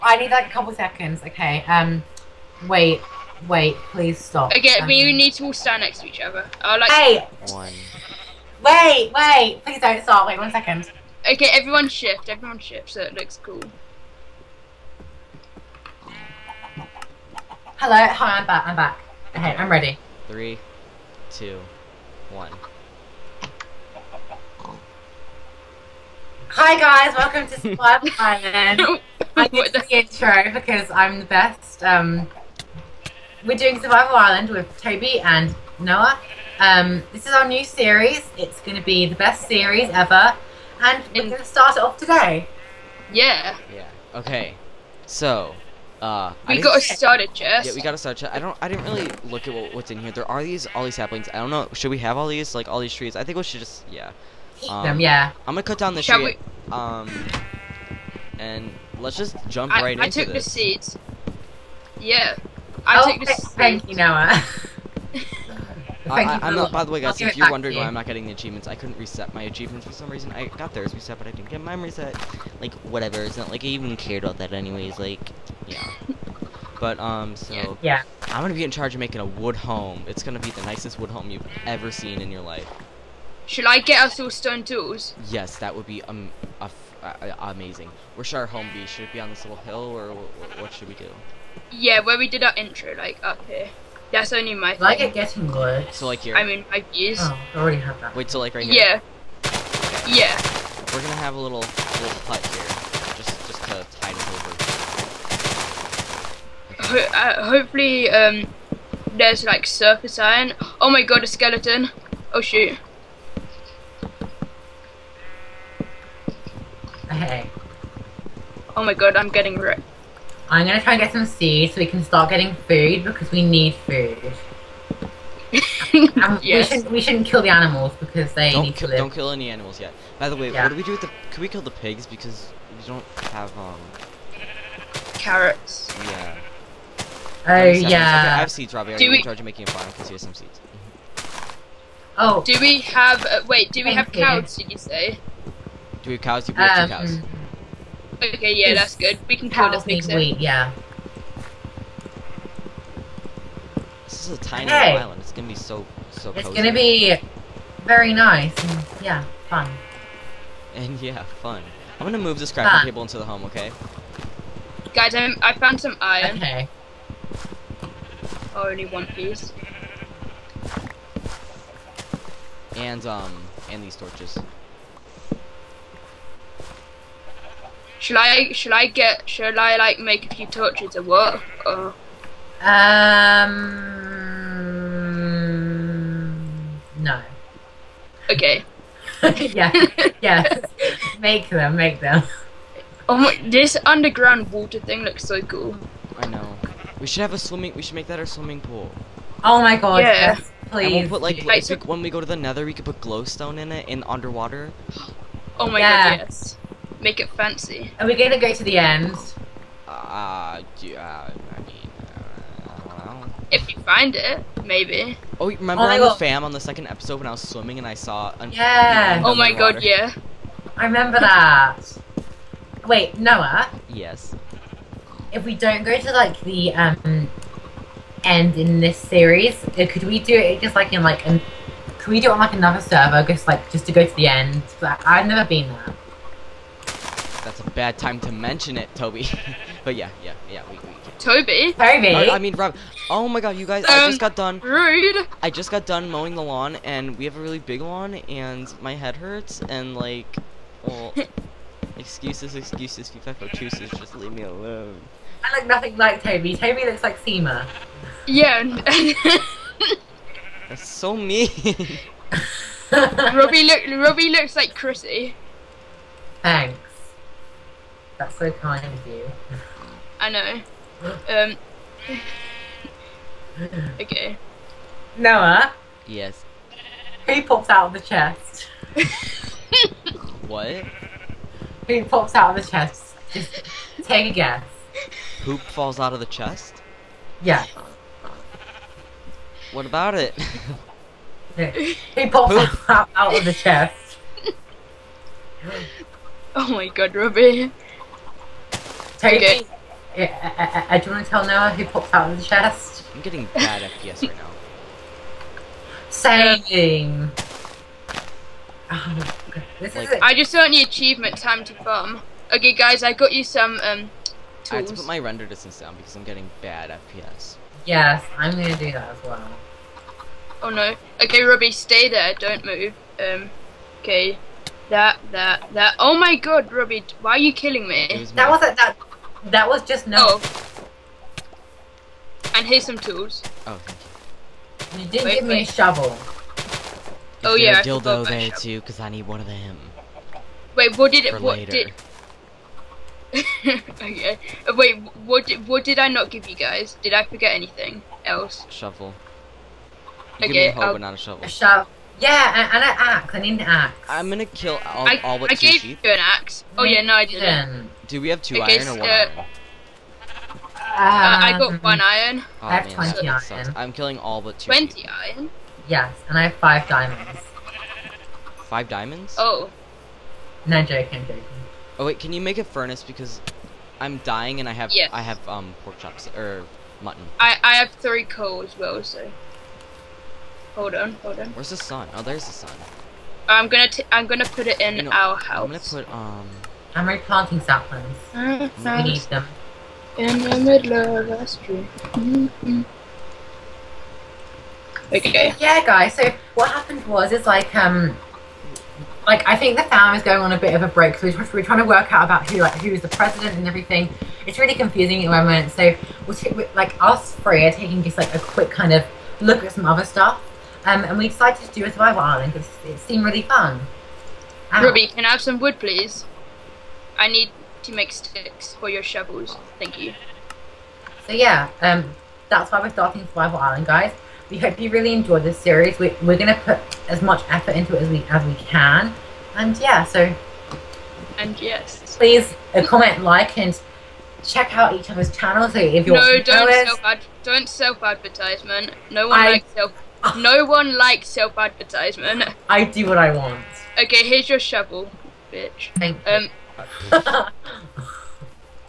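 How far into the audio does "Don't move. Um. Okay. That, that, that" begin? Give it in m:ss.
5:22.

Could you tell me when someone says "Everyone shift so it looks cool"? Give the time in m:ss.
0:12.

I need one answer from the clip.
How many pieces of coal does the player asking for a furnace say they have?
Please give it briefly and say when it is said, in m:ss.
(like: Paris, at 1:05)
3, at 6:17.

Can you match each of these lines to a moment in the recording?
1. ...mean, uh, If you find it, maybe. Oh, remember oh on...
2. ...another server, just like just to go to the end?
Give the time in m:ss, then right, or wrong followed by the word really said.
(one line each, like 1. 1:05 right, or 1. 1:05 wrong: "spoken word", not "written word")
1. 3:31 right
2. 3:52 right.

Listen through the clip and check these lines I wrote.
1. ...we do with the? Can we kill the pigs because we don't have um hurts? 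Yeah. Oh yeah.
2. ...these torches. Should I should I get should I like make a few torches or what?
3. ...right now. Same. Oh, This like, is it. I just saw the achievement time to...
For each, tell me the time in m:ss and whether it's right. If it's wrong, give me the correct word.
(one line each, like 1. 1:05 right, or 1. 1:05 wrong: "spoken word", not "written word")
1. 2:10 wrong: "carrots", not "hurts"
2. 2:53 right
3. 5:04 right.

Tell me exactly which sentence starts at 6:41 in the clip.
So we're trying to work out about who like who is the president and everything.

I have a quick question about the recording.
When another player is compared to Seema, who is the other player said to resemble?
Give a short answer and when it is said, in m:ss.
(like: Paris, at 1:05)
Chrissy, at 4:24.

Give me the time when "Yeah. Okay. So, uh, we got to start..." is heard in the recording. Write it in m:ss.
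0:43.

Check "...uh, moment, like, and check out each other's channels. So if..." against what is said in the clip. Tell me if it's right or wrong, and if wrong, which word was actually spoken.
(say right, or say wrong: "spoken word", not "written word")
wrong: "comment", not "moment".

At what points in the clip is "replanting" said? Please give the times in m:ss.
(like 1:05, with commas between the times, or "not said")
6:27.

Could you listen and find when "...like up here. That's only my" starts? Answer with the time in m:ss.
1:32.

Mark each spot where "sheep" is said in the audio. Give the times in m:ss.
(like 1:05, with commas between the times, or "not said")
5:55, 6:05.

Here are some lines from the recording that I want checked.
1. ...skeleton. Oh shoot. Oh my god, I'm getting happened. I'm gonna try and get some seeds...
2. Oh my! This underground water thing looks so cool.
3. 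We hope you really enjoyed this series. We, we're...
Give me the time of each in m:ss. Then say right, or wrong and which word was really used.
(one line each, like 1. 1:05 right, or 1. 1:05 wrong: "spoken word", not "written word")
1. 1:51 wrong: "ripped", not "happened"
2. 3:13 right
3. 7:04 right.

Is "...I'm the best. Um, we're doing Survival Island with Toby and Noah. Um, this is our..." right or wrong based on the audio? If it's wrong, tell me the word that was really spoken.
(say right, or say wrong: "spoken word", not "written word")
right.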